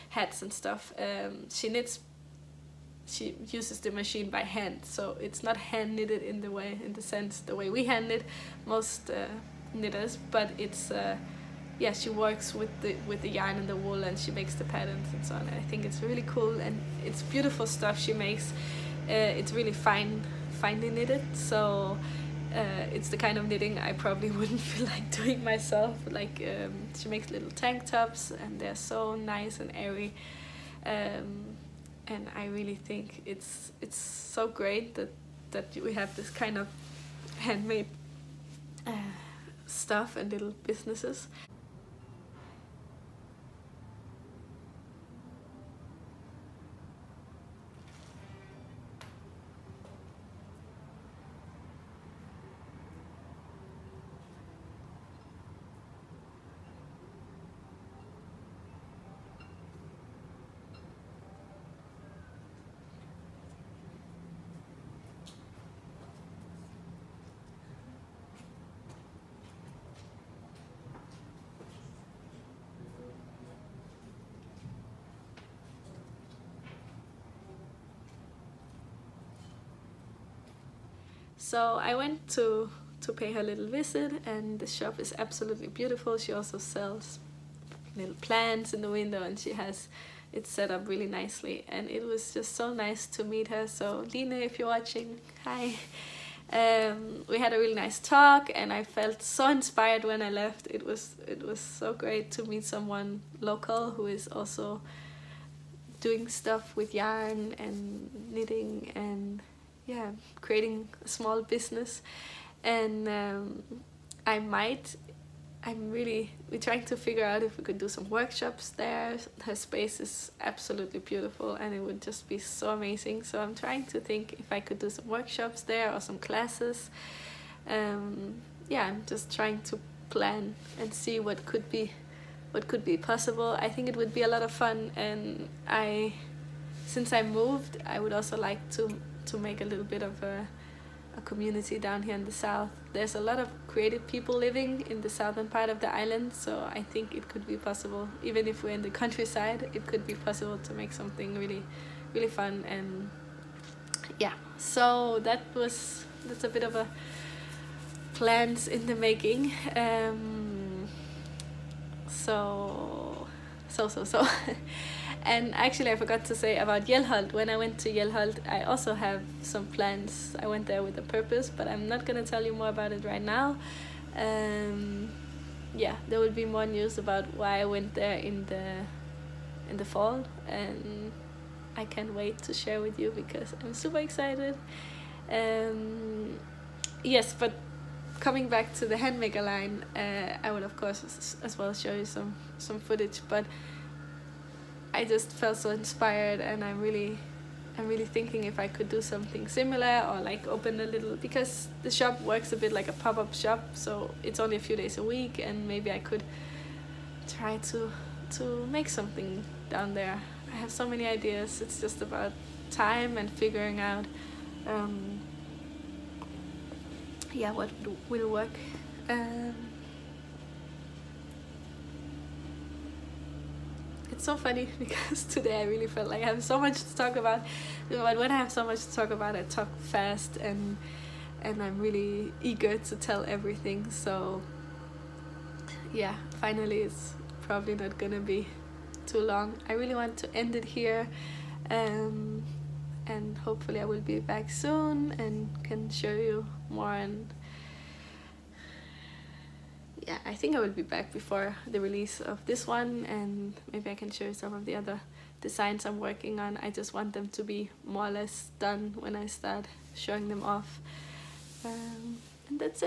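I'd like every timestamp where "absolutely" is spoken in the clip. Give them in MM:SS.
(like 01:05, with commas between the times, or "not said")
01:25, 02:00.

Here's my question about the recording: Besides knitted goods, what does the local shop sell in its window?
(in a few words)
plants.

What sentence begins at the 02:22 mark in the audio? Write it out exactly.
There's a lot of creative people living in the southern part of the island, so I think it could be possible.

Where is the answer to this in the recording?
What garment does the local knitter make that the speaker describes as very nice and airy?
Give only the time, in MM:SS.
00:27.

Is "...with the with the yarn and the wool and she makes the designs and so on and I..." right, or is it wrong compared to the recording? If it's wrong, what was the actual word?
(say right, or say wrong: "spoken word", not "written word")
wrong: "patterns", not "designs".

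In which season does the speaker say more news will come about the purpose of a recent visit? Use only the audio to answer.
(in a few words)
fall.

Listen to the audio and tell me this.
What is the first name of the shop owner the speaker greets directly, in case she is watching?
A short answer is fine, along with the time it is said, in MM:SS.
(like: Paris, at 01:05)
Lina, at 01:34.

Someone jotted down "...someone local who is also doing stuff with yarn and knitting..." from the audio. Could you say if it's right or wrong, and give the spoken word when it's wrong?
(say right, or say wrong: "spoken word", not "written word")
right.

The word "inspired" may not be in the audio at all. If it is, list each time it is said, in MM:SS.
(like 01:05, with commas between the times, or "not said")
01:39, 03:15.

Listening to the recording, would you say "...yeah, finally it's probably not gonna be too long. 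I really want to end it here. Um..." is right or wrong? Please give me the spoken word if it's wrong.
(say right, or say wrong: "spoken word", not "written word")
right.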